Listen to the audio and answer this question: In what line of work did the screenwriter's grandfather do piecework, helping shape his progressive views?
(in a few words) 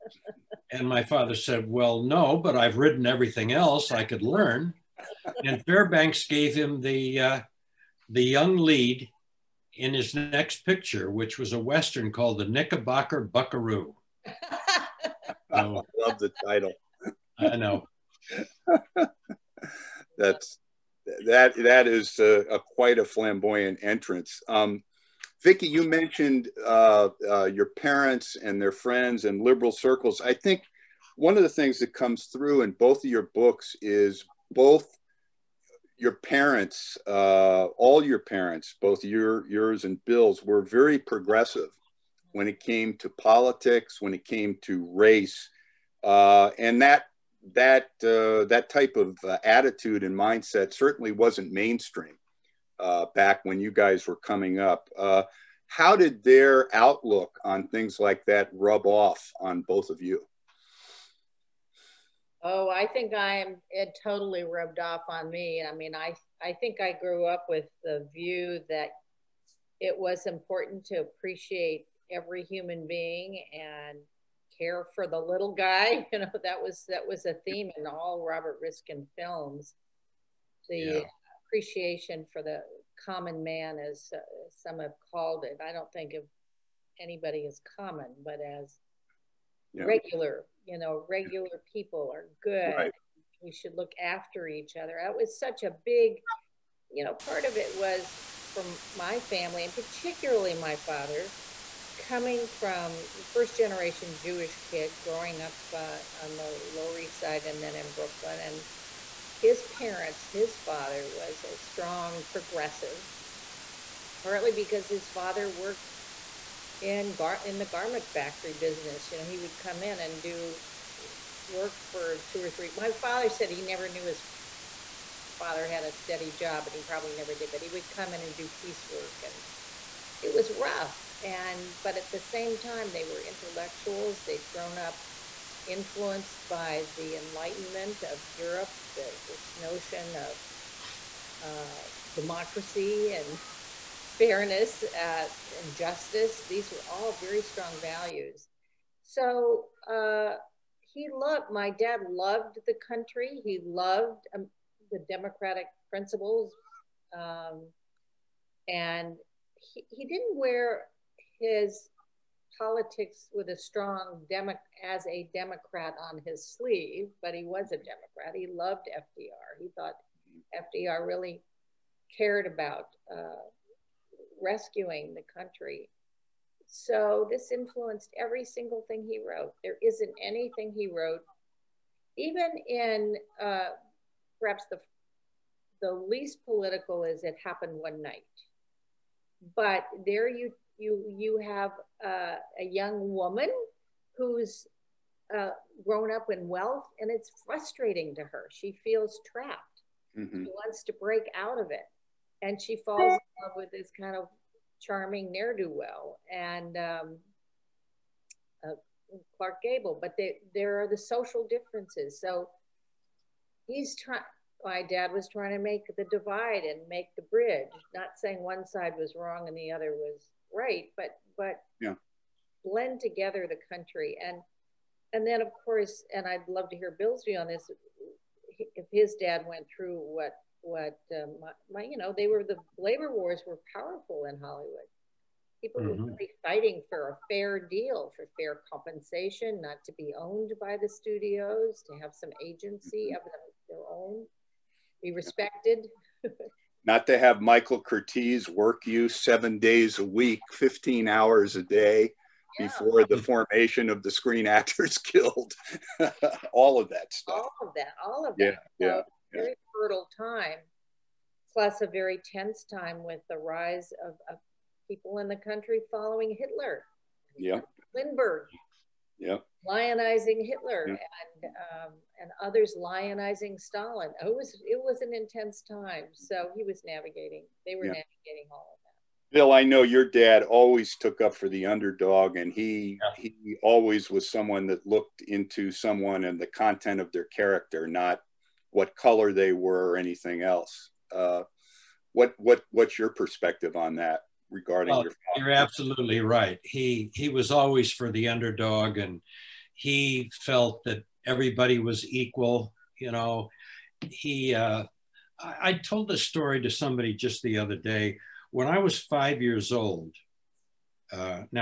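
garment factory business.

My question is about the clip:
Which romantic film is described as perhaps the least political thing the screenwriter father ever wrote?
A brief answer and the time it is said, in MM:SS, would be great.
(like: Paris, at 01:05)
It Happened One Night, at 03:07.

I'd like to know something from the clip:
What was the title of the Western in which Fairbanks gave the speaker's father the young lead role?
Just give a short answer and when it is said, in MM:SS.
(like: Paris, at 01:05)
The Knickerbocker Buckaroo, at 00:12.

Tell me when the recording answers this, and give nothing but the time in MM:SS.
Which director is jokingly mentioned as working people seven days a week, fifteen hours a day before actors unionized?
04:07.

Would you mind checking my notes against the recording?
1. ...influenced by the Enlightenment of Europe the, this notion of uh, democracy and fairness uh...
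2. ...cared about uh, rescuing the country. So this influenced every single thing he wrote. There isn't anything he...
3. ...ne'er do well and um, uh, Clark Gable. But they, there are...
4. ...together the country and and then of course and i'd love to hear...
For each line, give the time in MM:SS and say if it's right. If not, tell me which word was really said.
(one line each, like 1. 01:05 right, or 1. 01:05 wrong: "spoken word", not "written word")
1. 02:15 right
2. 02:52 right
3. 03:25 right
4. 03:43 right.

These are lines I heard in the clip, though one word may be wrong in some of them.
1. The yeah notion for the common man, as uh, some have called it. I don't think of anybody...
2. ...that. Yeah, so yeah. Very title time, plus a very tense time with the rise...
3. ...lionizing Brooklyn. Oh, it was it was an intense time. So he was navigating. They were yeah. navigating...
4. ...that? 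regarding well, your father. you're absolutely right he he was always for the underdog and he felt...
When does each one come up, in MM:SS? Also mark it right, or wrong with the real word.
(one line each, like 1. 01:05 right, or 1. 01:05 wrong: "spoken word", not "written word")
1. 01:20 wrong: "appreciation", not "notion"
2. 04:18 wrong: "fertile", not "title"
3. 04:32 wrong: "Stalin", not "Brooklyn"
4. 04:53 right.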